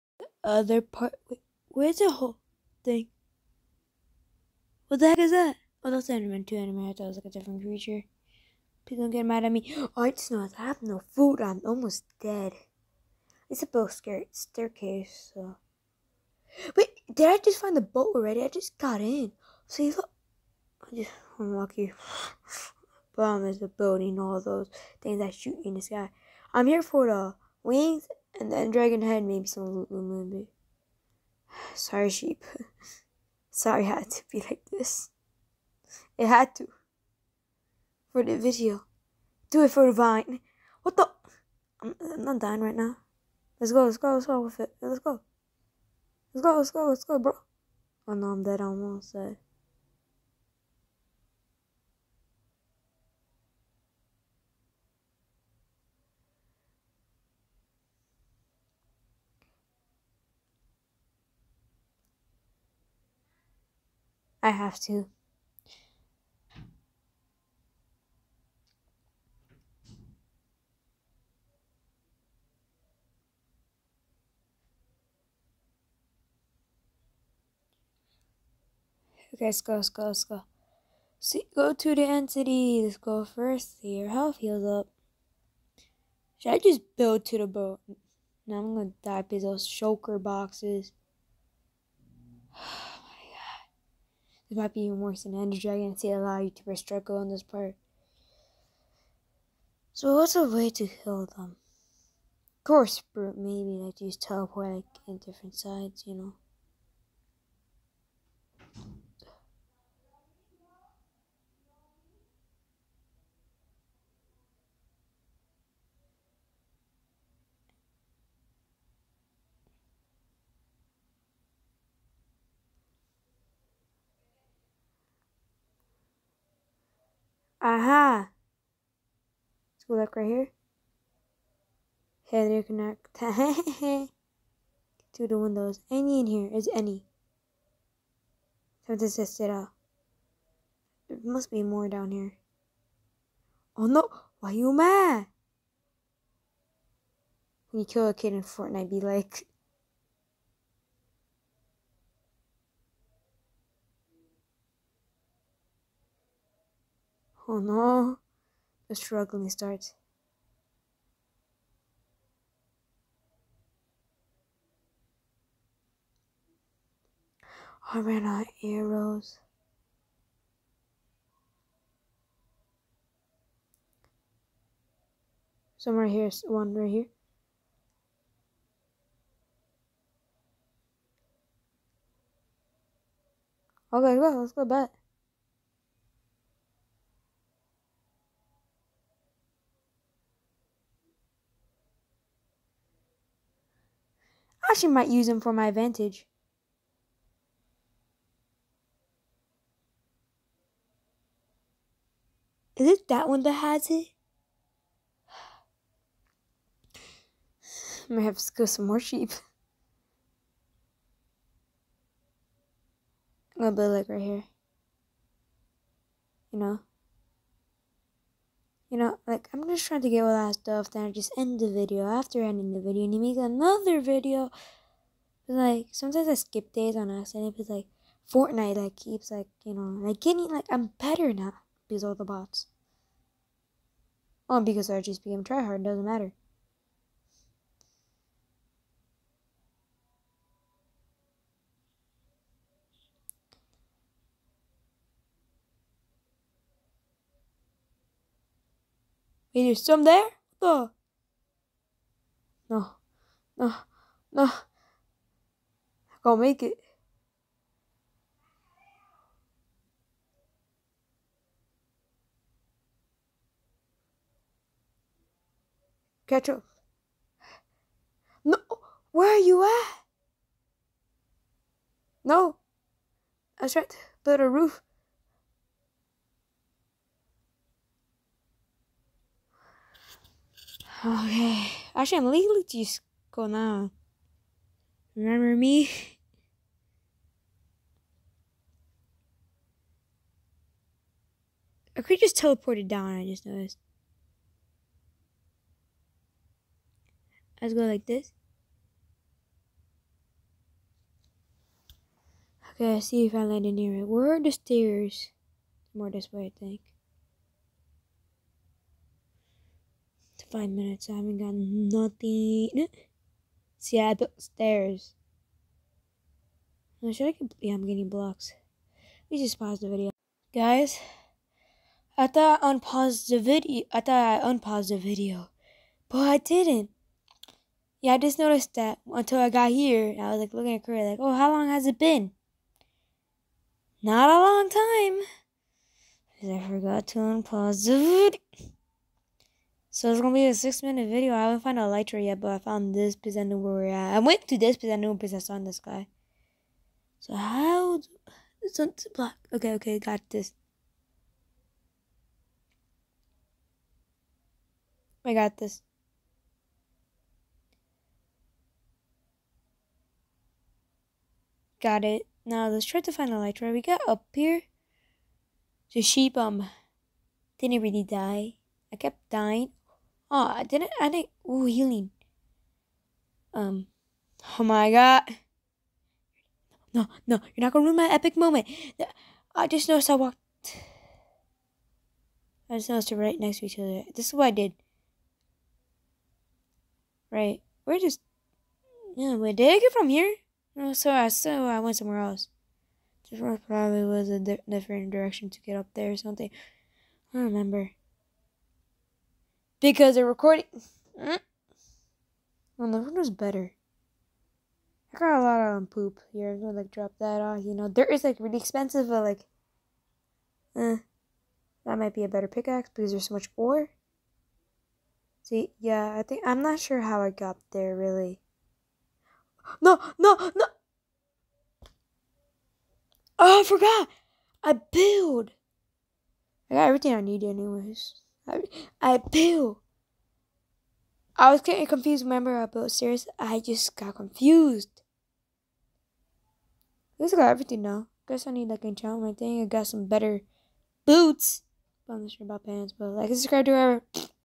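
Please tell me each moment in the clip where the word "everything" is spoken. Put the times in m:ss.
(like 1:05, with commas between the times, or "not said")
7:06, 7:17.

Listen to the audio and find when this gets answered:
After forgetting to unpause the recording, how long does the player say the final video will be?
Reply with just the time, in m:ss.
5:40.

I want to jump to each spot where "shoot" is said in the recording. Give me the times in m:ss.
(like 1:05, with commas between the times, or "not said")
0:25.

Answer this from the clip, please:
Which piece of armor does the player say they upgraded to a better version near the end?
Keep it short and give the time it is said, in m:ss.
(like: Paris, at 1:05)
boots, at 7:21.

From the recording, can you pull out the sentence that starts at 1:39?
So what's a way to heal them?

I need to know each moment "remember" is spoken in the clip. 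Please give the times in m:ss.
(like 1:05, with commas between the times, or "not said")
4:45, 6:37, 7:12.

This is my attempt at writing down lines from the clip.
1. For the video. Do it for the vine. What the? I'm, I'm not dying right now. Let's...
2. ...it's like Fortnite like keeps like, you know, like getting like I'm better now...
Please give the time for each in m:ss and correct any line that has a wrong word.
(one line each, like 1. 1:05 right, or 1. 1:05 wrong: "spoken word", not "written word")
1. 0:38 right
2. 3:47 right.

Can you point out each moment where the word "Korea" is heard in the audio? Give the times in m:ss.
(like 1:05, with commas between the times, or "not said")
5:30.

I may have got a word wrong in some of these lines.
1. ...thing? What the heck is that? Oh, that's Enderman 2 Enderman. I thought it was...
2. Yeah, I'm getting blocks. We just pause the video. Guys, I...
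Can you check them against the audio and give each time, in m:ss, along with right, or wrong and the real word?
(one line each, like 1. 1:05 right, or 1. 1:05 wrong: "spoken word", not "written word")
1. 0:02 right
2. 5:17 right.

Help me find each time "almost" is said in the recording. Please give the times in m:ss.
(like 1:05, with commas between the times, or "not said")
0:11, 0:48.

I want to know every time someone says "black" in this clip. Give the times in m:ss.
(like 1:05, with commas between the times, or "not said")
5:49.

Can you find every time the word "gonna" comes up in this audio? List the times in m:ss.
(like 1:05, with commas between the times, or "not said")
1:28, 4:43, 5:40, 6:17, 6:46.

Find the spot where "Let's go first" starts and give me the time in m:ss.
1:22.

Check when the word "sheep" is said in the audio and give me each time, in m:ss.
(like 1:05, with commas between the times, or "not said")
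0:32, 3:29, 6:06.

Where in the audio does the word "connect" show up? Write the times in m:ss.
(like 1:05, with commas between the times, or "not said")
2:12.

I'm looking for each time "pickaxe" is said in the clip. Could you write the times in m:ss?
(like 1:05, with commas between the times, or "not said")
6:52.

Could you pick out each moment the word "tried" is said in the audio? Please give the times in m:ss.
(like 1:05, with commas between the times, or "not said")
4:33.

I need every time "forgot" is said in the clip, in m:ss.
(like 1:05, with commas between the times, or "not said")
5:36, 7:03.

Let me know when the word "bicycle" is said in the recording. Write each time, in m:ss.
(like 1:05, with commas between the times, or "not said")
not said.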